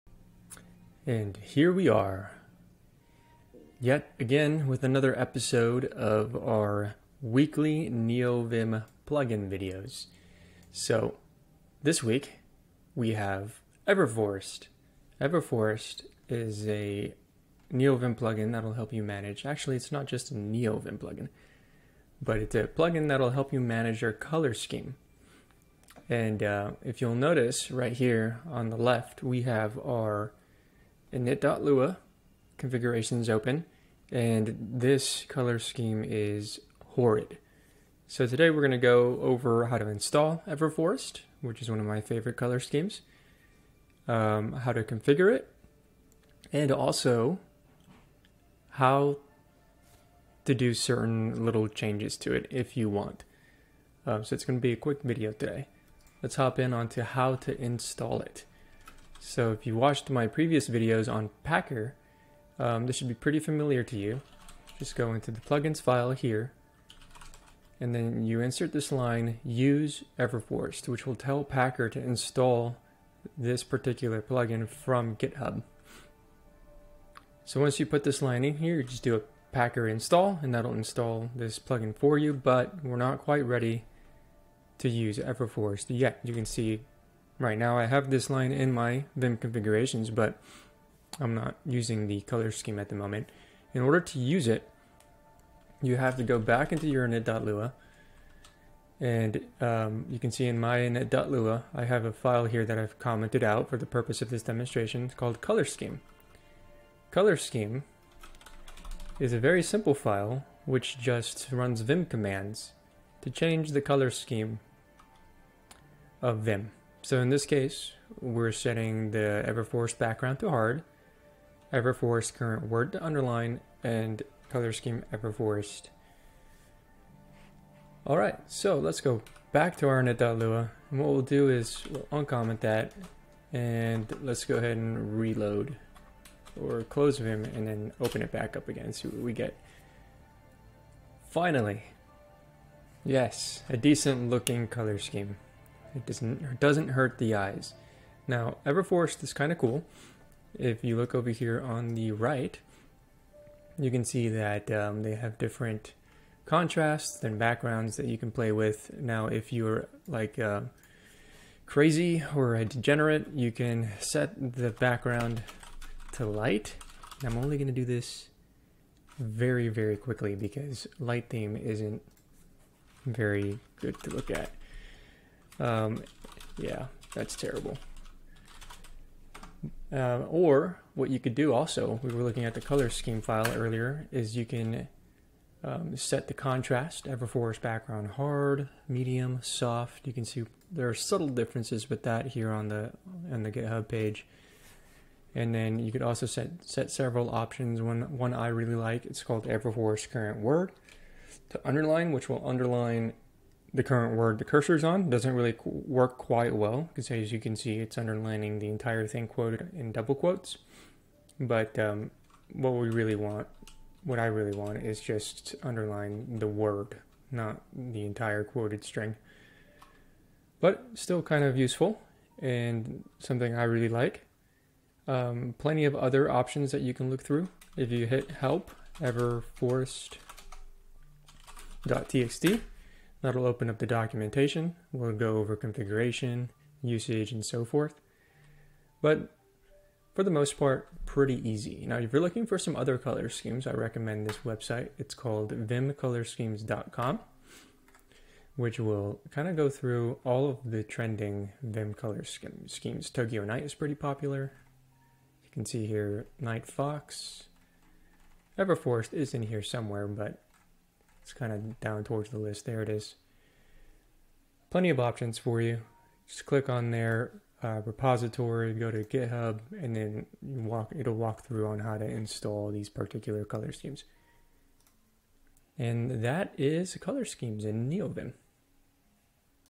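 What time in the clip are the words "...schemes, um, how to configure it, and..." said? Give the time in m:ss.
0:42.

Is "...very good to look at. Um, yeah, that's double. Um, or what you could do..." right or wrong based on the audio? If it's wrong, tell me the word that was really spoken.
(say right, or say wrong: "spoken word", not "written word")
wrong: "terrible", not "double".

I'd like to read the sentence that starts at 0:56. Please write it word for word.
Let's hop in onto how to install it.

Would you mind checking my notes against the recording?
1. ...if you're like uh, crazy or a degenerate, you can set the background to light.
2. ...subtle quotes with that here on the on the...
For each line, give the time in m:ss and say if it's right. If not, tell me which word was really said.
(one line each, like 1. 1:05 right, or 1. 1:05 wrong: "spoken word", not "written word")
1. 2:39 right
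2. 3:10 wrong: "differences", not "quotes".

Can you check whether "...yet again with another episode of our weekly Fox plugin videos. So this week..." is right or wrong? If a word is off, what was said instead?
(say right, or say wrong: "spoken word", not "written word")
wrong: "NeoVim", not "Fox".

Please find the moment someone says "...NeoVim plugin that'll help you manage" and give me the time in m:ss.
0:17.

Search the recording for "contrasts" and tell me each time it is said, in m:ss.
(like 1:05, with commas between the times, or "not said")
2:36, 3:06.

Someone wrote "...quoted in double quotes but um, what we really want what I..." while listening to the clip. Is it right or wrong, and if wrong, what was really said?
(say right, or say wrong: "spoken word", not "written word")
right.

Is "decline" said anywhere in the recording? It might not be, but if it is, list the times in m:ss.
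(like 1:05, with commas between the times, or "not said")
not said.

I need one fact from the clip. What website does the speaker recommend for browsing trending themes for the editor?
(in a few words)
vimcolorschemes.com.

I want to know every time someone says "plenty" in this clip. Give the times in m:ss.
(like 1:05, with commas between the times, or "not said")
3:45, 4:24.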